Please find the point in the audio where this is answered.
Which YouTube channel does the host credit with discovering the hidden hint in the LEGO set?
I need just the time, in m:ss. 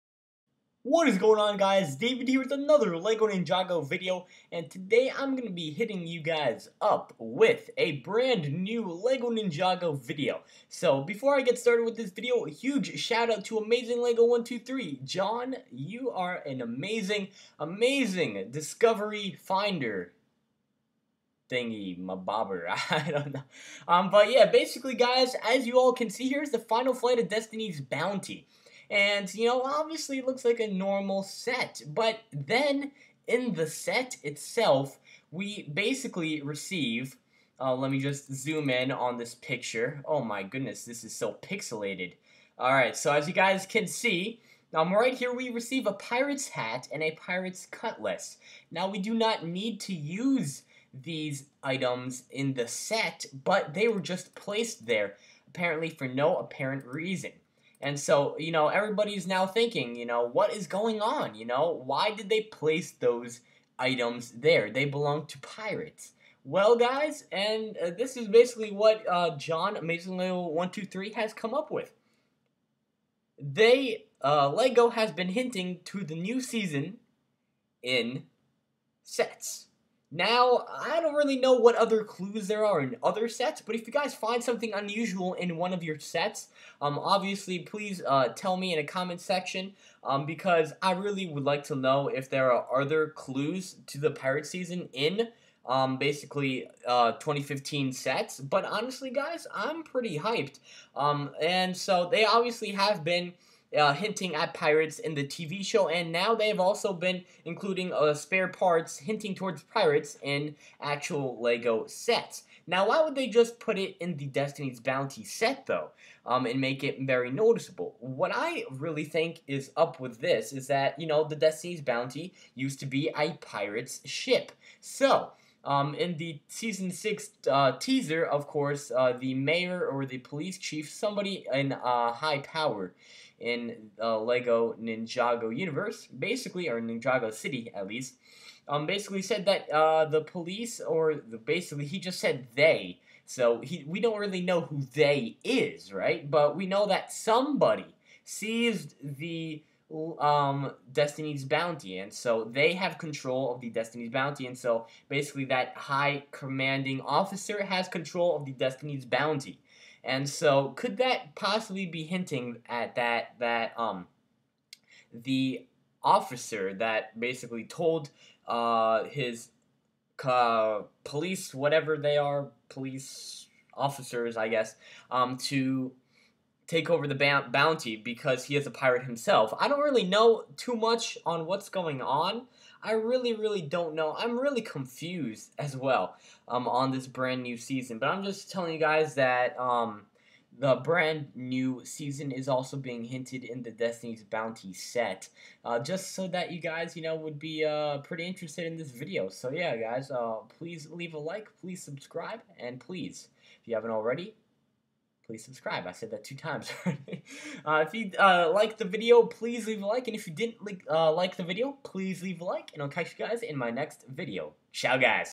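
0:13.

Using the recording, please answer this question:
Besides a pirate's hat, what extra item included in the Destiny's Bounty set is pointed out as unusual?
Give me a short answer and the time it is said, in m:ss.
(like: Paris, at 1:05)
pirate's cutlass, at 0:47.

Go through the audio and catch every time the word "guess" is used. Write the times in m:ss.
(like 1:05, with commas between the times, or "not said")
2:54.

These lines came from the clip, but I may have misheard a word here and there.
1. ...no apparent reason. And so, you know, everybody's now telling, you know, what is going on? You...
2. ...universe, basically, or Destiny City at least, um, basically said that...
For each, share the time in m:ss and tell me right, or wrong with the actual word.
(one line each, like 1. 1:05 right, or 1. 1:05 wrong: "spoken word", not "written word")
1. 0:56 wrong: "thinking", not "telling"
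2. 2:15 wrong: "Ninjago", not "Destiny".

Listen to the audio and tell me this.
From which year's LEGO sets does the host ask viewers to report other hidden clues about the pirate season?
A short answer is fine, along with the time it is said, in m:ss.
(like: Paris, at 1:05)
2015, at 1:37.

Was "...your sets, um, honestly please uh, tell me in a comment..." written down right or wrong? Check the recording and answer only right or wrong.
wrong.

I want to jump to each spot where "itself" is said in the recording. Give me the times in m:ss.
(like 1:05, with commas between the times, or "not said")
0:34.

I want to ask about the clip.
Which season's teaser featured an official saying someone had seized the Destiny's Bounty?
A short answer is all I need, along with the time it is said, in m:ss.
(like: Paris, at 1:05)
season six, at 2:06.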